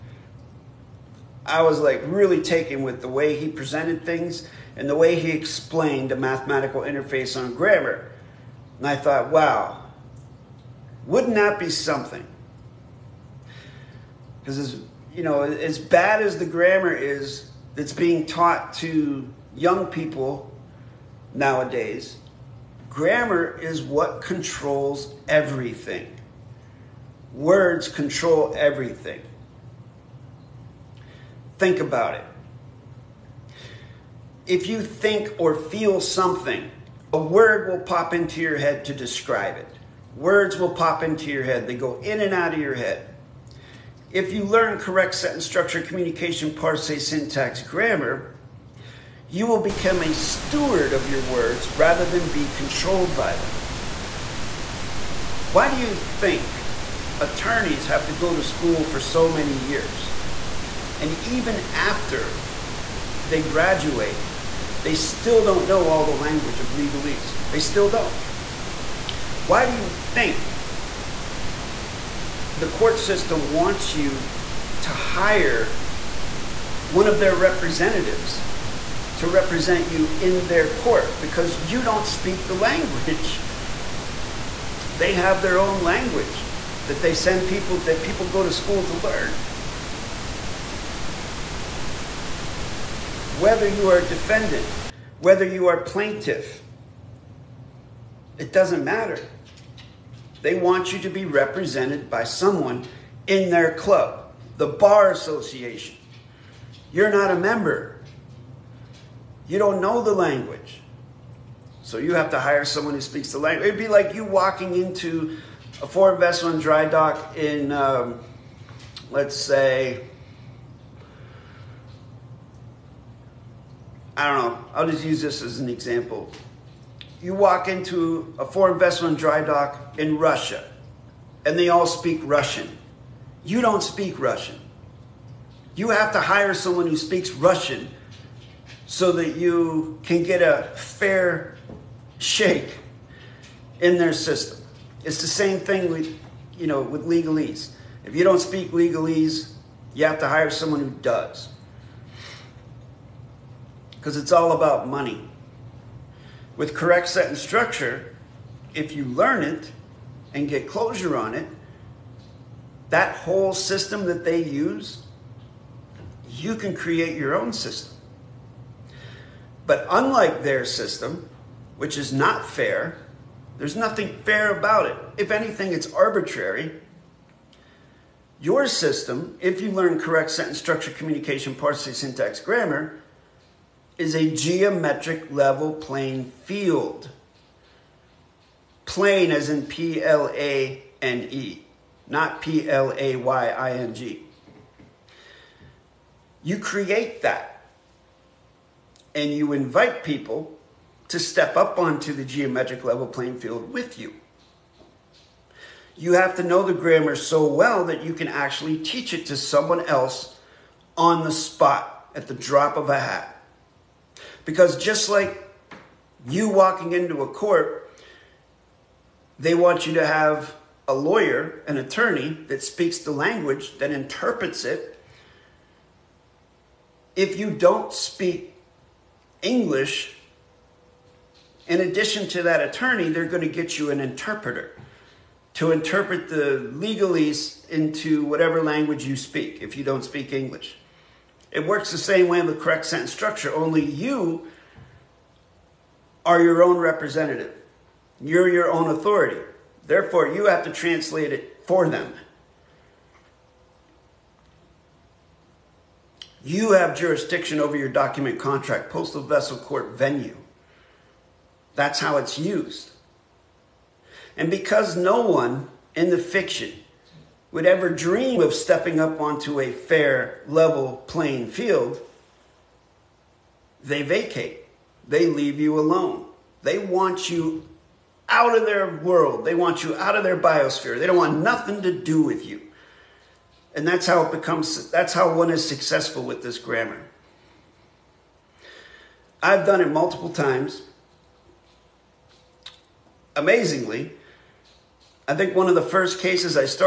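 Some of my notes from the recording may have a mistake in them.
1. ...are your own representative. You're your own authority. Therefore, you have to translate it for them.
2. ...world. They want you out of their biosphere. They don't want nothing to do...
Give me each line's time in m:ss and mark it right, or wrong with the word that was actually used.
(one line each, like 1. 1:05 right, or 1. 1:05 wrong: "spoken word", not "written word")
1. 4:06 right
2. 4:38 right.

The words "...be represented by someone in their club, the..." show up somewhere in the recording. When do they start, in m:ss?
1:41.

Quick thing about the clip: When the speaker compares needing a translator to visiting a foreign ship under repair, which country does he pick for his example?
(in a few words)
Russia.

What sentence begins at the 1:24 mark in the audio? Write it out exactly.
They have their own language that they send people, that people go to school to learn.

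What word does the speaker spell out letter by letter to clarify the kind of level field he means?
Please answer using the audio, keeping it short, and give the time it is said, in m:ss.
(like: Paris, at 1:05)
Plane, at 3:08.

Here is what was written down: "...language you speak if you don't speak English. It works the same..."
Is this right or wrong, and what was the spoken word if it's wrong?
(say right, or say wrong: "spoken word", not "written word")
right.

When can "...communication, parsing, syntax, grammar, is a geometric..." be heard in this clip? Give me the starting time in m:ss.
3:00.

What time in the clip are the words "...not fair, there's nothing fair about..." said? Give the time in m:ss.
2:52.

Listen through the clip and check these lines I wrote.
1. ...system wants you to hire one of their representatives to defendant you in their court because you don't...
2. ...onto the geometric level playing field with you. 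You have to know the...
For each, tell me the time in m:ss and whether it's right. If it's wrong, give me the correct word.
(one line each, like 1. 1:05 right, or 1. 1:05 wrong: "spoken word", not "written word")
1. 1:12 wrong: "represent", not "defendant"
2. 3:21 right.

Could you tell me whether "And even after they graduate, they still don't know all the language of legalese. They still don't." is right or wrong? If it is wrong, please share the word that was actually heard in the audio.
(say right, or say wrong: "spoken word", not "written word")
right.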